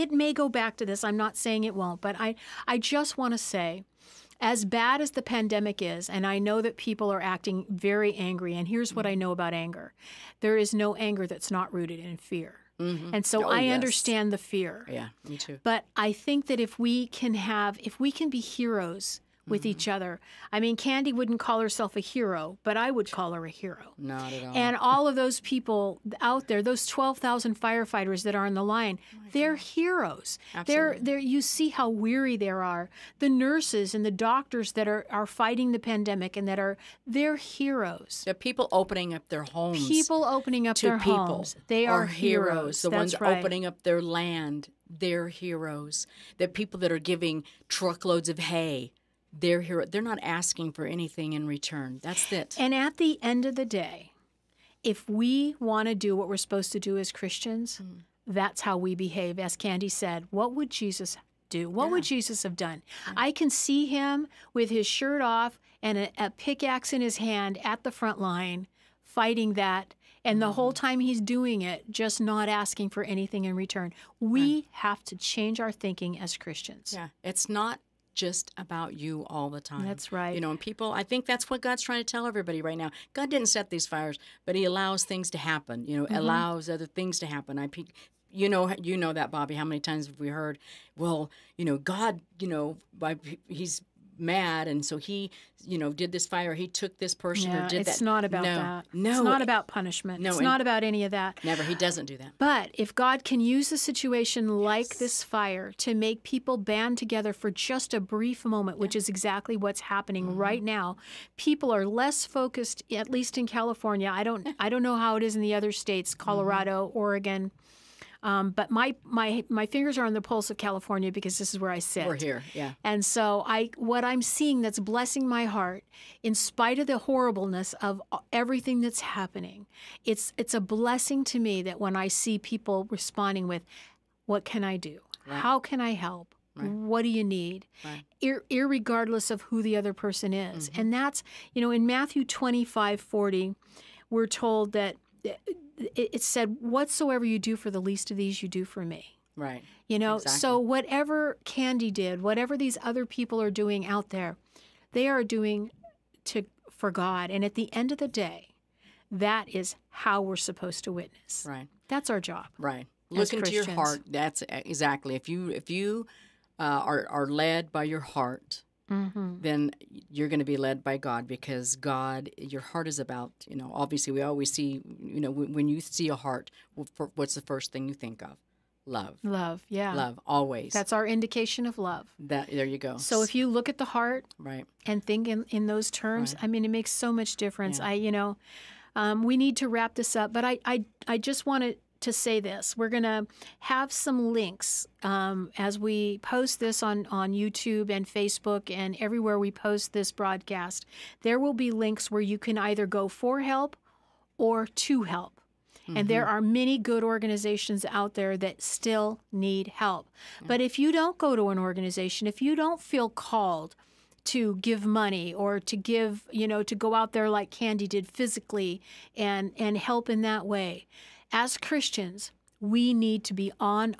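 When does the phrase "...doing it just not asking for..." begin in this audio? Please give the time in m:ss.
1:11.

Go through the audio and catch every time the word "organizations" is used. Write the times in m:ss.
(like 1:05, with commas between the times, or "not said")
3:27, 3:31.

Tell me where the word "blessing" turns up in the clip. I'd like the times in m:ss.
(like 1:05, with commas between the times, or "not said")
2:04, 2:10.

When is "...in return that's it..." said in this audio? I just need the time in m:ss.
0:51.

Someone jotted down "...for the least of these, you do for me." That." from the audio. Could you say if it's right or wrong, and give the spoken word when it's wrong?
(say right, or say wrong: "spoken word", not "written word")
wrong: "Right", not "That".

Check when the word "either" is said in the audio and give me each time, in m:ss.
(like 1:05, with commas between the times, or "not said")
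3:22.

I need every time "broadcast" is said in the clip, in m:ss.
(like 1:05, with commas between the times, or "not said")
3:20.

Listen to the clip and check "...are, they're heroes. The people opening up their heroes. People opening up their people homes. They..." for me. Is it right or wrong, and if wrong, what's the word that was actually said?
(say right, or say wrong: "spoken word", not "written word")
wrong: "homes", not "heroes".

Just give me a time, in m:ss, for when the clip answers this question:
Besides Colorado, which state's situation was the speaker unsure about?
1:56.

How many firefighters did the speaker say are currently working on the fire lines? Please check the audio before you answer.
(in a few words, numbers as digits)
12,000.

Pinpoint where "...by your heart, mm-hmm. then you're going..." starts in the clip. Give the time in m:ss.
2:47.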